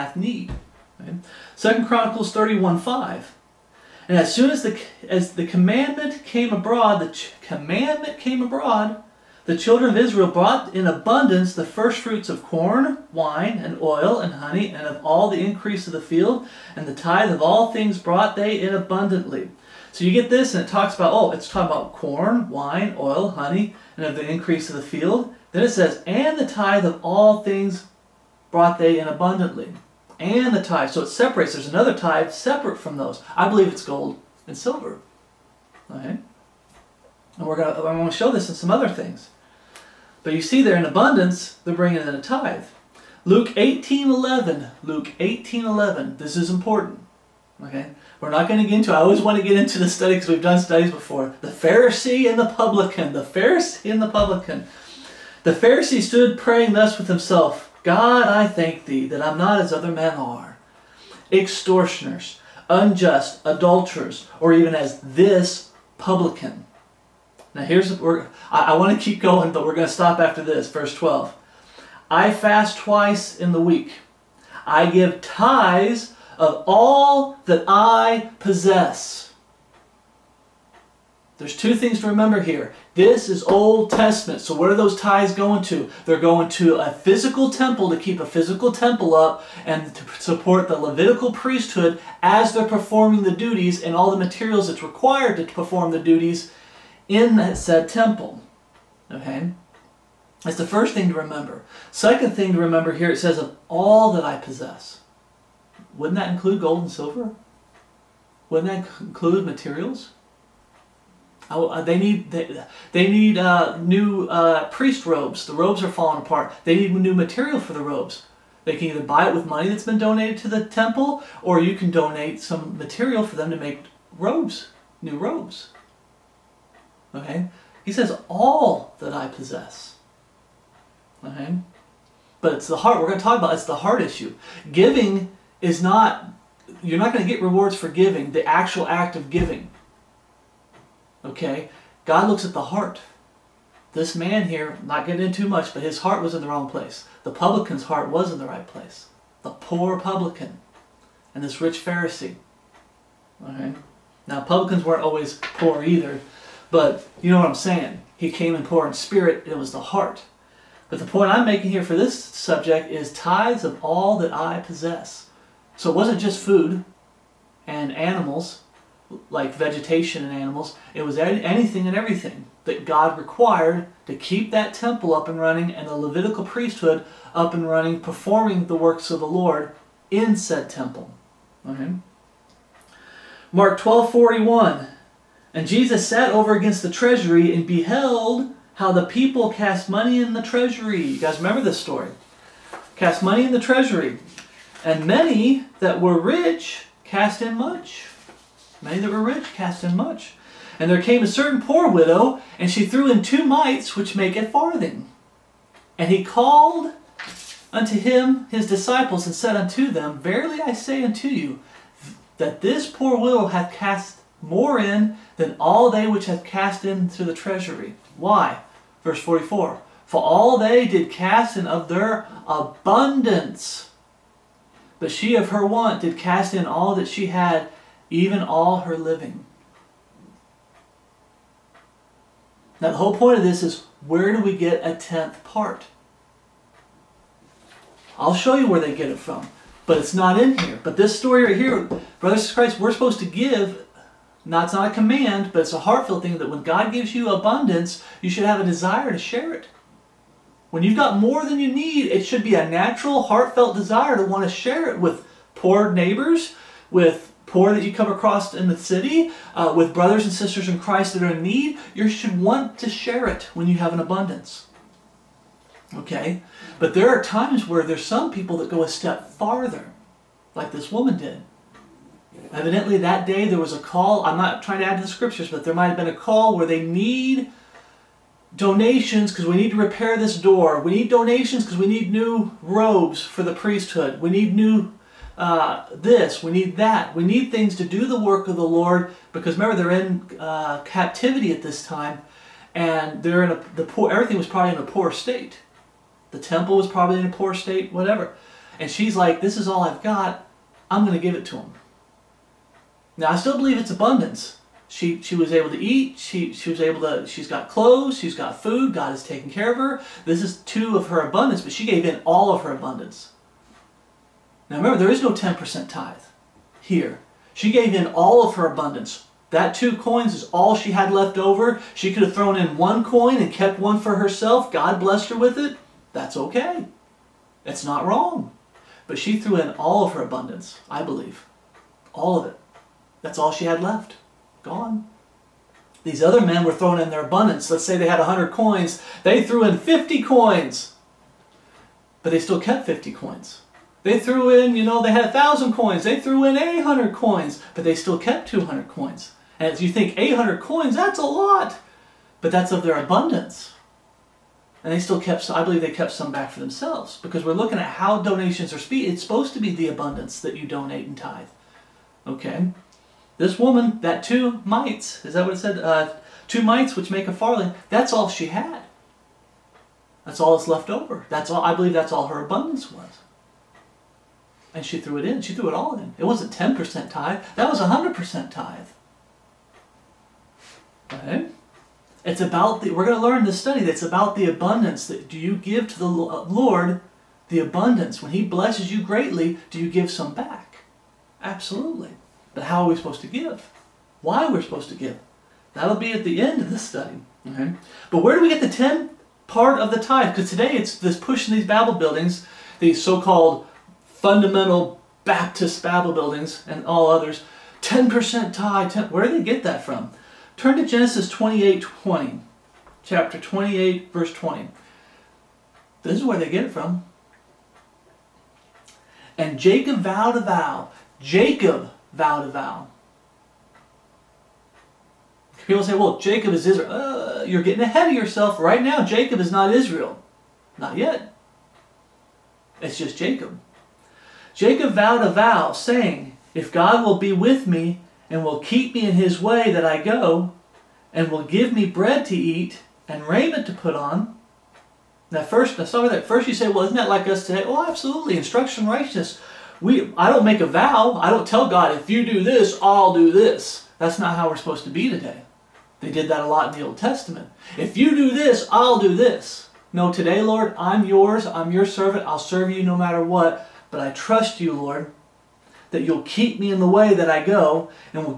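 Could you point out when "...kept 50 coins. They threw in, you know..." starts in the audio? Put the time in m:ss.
5:42.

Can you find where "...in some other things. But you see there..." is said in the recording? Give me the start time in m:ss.
0:38.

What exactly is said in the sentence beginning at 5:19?
That two coins is all she had left over.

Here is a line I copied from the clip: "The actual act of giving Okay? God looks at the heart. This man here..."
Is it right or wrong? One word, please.
right.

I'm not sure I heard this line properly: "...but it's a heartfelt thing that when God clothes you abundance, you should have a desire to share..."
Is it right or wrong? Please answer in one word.
wrong.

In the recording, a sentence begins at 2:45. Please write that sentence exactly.
So it wasn't just food and animals, like vegetation and animals.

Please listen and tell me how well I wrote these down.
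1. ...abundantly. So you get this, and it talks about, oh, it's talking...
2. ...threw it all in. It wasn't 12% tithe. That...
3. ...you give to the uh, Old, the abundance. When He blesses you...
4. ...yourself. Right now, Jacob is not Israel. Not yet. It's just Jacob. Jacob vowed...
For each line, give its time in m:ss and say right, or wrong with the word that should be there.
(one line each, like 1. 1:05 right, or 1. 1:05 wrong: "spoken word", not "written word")
1. 0:18 right
2. 6:15 wrong: "10", not "12"
3. 6:25 wrong: "Lord", not "Old"
4. 7:08 right.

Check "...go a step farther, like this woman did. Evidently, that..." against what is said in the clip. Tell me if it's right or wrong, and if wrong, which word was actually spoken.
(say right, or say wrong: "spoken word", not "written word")
right.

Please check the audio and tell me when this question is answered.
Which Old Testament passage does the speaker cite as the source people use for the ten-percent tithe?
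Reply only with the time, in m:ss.
6:50.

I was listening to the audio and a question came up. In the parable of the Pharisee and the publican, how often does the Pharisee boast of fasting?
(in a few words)
Twice in the week.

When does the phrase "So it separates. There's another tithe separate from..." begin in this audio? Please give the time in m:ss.
0:30.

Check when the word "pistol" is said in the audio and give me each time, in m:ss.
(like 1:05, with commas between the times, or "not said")
not said.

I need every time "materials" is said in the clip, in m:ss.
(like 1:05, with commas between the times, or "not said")
1:34, 1:49, 1:57, 2:02.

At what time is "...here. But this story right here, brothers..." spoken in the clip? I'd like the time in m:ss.
4:00.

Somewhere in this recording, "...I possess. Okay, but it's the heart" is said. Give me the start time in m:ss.
2:09.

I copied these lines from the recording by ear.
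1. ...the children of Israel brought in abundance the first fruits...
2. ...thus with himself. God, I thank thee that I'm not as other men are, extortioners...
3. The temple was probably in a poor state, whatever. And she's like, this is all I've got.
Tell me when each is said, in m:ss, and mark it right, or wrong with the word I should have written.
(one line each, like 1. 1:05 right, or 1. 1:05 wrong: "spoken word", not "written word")
1. 0:09 right
2. 0:56 right
3. 4:56 right.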